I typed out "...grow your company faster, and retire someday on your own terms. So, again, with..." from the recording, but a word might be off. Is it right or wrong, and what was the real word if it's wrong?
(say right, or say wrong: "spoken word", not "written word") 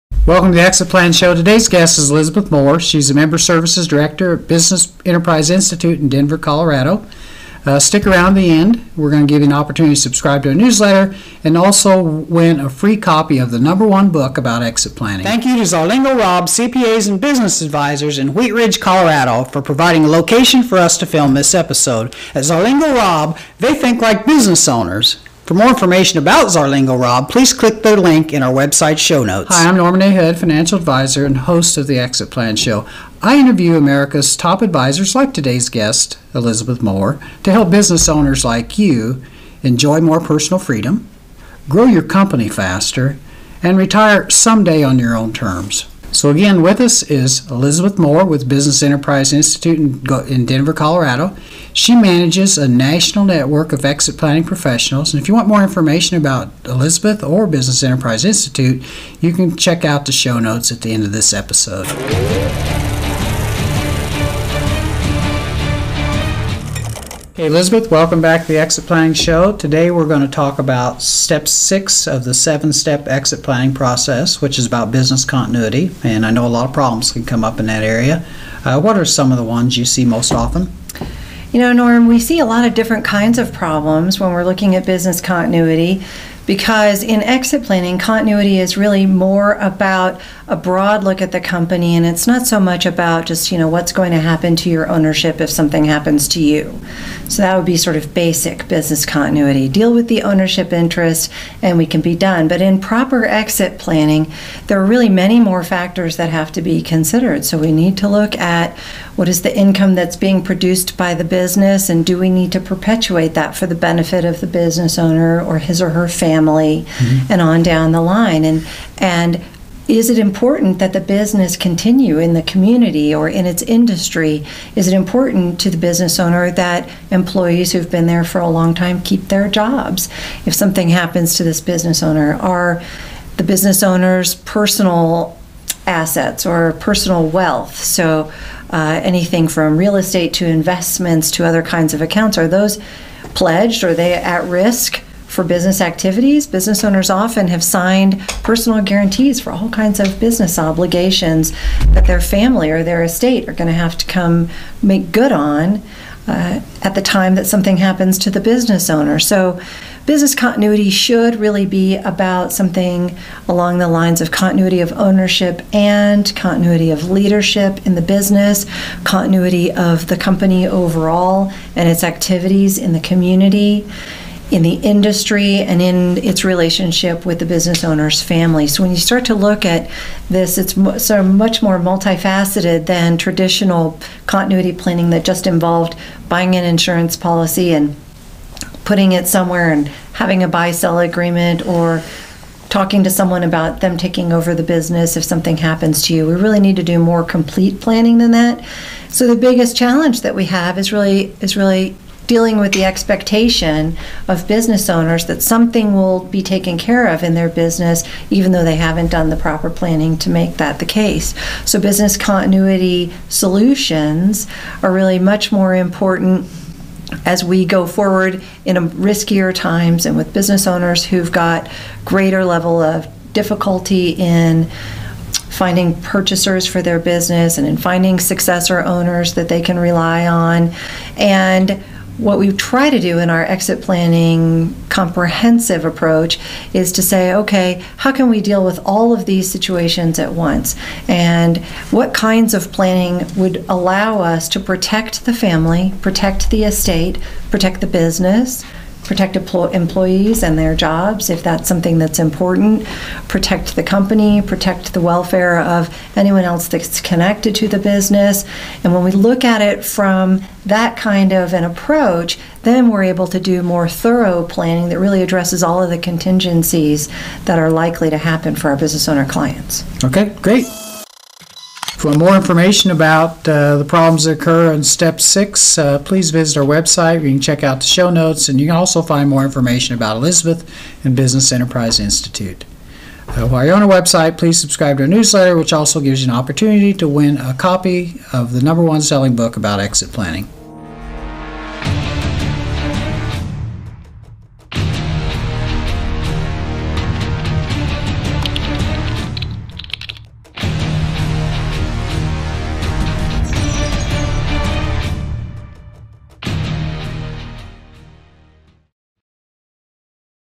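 right.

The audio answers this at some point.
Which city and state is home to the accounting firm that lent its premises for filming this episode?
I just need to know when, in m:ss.
0:18.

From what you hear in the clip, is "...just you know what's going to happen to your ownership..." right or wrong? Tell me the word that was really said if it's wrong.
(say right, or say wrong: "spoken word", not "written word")
right.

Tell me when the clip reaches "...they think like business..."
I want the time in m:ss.
0:23.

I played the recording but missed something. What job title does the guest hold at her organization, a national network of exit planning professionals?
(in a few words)
Member Services Director.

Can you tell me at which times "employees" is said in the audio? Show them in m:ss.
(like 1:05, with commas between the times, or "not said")
2:07, 4:09.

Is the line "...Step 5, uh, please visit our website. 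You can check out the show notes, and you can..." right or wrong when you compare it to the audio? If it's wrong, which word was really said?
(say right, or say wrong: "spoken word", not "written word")
wrong: "6", not "5".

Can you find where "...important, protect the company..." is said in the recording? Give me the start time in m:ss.
4:12.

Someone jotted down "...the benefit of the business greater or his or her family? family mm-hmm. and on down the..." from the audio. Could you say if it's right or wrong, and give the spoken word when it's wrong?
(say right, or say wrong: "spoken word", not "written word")
wrong: "owner", not "greater".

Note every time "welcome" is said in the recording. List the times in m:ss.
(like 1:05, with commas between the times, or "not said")
0:00, 1:07.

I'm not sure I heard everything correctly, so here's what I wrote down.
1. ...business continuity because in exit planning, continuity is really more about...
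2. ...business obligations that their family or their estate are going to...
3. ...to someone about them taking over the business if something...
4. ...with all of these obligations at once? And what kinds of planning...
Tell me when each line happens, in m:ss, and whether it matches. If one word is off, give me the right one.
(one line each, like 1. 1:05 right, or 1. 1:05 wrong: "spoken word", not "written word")
1. 1:24 right
2. 2:30 right
3. 3:13 right
4. 3:58 wrong: "situations", not "obligations".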